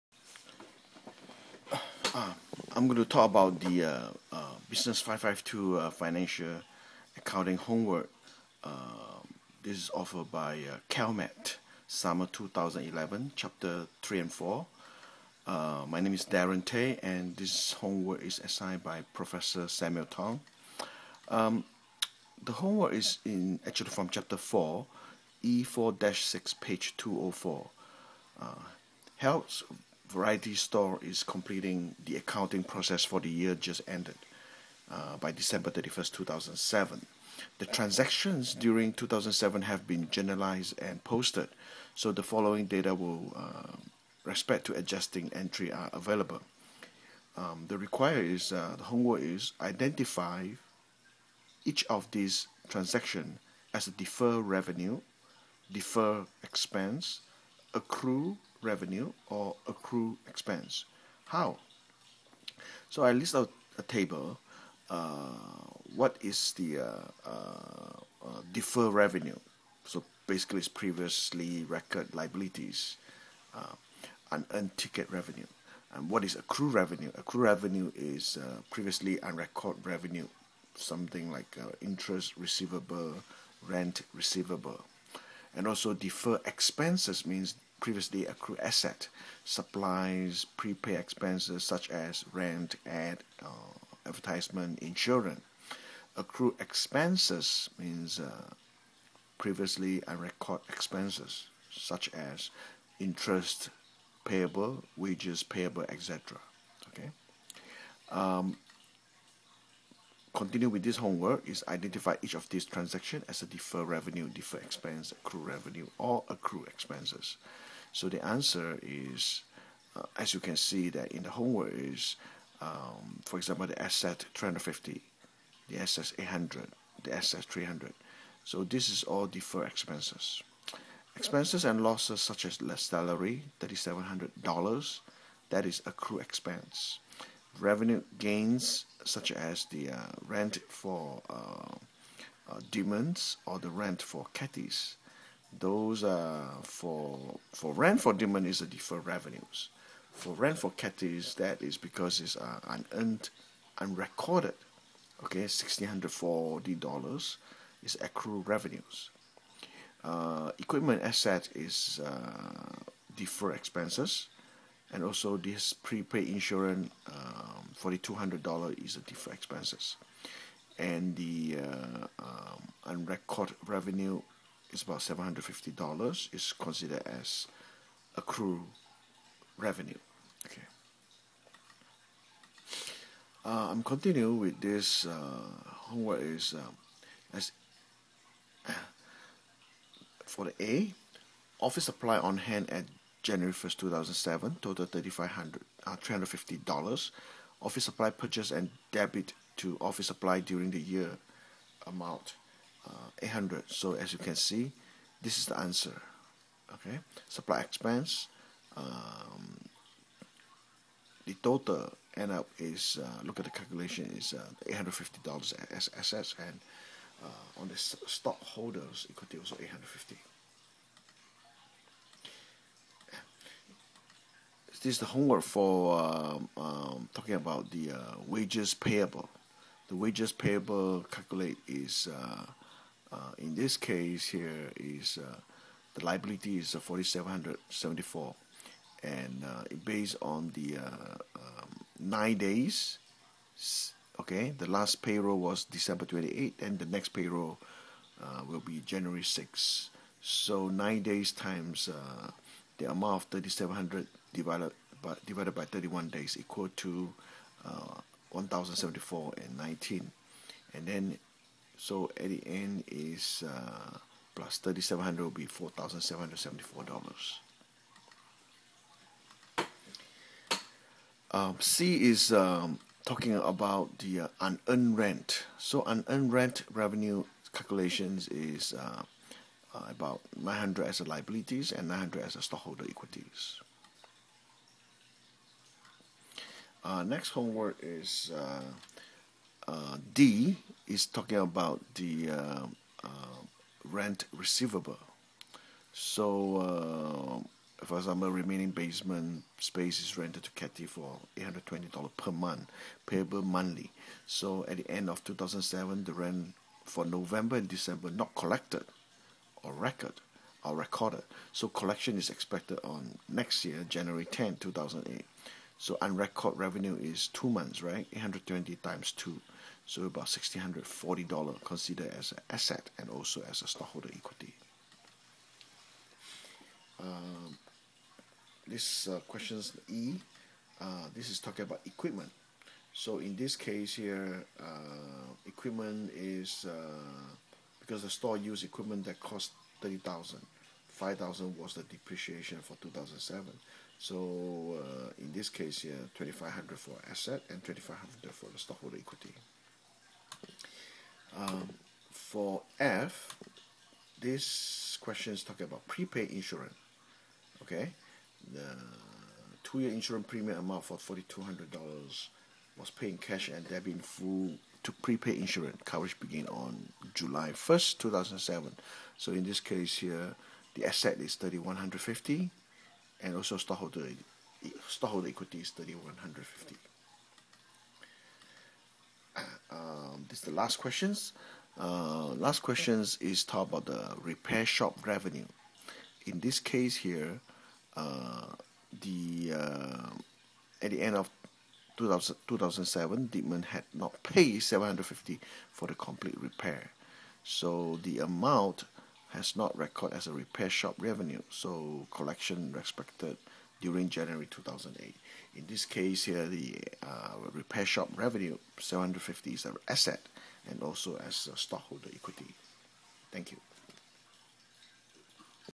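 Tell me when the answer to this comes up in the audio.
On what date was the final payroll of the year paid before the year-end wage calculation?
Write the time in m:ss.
4:05.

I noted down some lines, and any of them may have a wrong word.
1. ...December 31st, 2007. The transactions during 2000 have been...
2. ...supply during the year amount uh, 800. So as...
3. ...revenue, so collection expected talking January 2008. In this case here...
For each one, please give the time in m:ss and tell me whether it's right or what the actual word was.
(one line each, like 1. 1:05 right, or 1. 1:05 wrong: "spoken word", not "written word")
1. 0:35 wrong: "2007", not "2000"
2. 3:20 right
3. 6:40 wrong: "during", not "talking".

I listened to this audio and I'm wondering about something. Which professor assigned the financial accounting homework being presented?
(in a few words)
Samuel Tong.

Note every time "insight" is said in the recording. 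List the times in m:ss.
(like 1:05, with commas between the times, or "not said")
not said.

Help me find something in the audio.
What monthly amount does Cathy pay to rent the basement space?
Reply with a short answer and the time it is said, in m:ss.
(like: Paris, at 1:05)
$820, at 5:01.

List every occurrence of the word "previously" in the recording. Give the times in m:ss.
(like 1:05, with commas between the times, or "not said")
1:10, 1:18, 1:27, 1:39.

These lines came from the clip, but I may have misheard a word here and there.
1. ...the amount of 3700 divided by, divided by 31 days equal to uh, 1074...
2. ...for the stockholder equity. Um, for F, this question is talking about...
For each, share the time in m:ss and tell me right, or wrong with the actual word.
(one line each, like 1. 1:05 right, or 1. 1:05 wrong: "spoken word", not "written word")
1. 4:12 right
2. 5:48 right.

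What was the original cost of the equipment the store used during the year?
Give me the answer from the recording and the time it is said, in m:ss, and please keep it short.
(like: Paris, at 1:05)
30,000, at 5:39.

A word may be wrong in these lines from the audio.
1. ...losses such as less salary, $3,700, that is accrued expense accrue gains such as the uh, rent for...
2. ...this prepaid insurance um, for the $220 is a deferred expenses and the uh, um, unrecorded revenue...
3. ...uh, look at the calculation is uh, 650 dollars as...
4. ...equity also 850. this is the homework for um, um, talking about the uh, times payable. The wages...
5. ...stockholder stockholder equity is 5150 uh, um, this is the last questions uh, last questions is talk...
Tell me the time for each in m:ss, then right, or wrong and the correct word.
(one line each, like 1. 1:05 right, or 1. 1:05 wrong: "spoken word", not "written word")
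1. 2:11 wrong: "revenue", not "accrue"
2. 2:45 wrong: "200", not "220"
3. 3:32 wrong: "850", not "650"
4. 3:39 wrong: "wages", not "times"
5. 6:13 wrong: "3150", not "5150".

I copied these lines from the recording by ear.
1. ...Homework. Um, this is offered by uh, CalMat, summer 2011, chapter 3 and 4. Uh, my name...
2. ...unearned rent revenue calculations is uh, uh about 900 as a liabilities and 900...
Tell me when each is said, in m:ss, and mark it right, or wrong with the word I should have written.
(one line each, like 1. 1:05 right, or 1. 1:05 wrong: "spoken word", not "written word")
1. 0:07 right
2. 4:35 right.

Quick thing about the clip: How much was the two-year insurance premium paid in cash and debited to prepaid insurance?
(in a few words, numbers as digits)
$4,200.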